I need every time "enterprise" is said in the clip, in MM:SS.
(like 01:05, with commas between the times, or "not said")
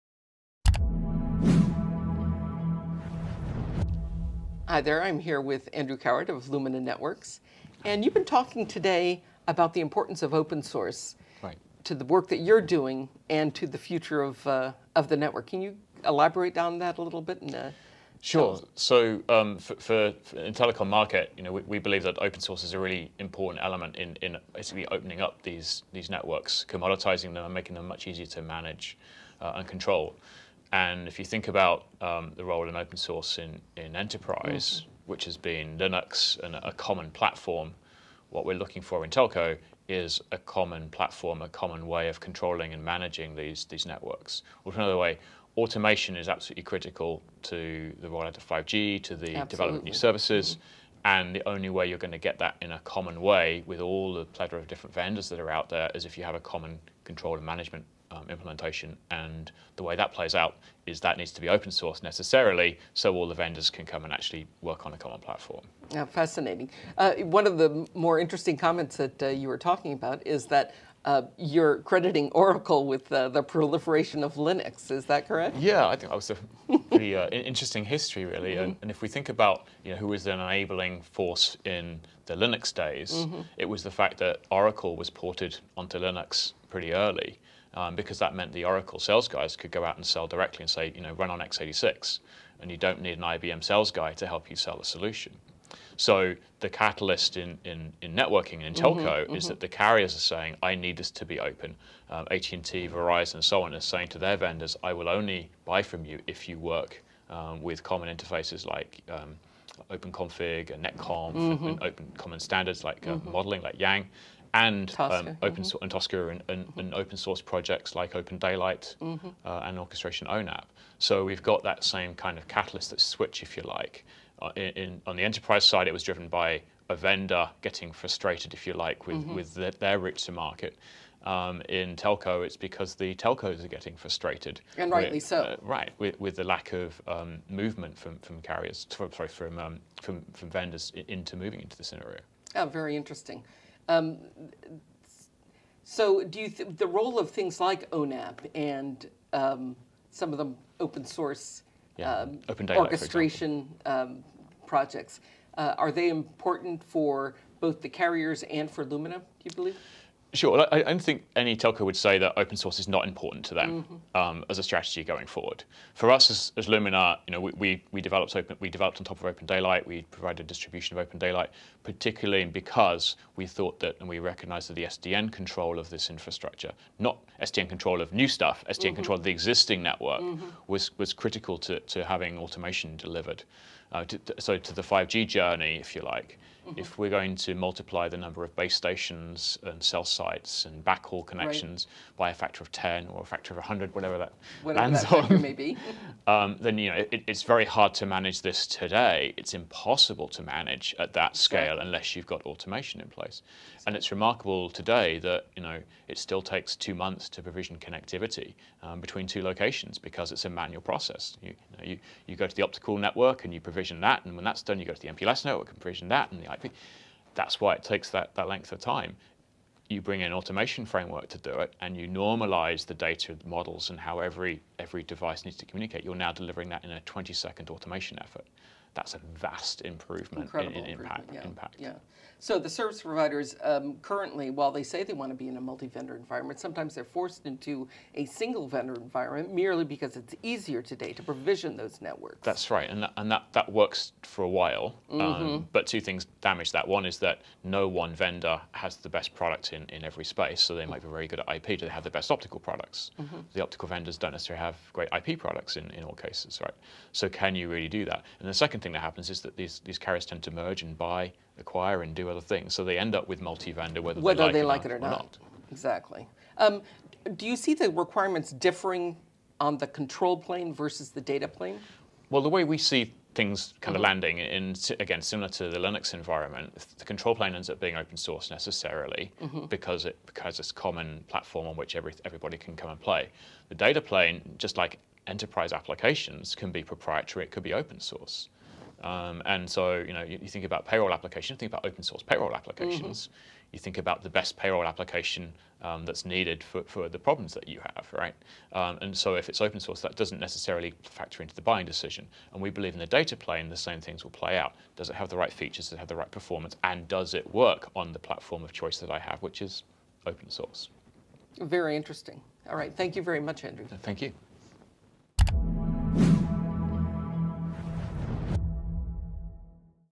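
00:33, 02:05, 04:45.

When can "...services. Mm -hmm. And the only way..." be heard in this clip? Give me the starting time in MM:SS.
00:49.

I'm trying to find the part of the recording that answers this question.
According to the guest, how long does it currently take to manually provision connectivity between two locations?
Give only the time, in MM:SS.
03:26.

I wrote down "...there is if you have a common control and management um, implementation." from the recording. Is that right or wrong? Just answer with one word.
right.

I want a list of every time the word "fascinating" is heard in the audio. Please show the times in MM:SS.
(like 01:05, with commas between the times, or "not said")
01:06.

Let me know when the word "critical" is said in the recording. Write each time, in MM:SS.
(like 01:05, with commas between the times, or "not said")
00:46, 03:01.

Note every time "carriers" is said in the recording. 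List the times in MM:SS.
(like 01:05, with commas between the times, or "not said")
01:39, 02:18, 02:37, 04:19.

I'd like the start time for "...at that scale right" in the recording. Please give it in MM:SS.
03:20.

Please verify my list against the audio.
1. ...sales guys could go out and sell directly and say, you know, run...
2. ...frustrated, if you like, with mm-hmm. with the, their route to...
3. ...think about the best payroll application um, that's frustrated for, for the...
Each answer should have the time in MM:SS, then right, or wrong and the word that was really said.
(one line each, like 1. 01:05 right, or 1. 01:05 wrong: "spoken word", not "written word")
1. 01:28 right
2. 02:07 right
3. 04:53 wrong: "needed", not "frustrated".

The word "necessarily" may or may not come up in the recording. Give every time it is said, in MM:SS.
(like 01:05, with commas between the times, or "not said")
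01:02, 04:14, 04:38, 05:00.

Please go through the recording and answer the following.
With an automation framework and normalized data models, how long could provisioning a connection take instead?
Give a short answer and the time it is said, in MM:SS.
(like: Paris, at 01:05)
20 seconds, at 03:47.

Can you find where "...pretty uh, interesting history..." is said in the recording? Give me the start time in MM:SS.
01:16.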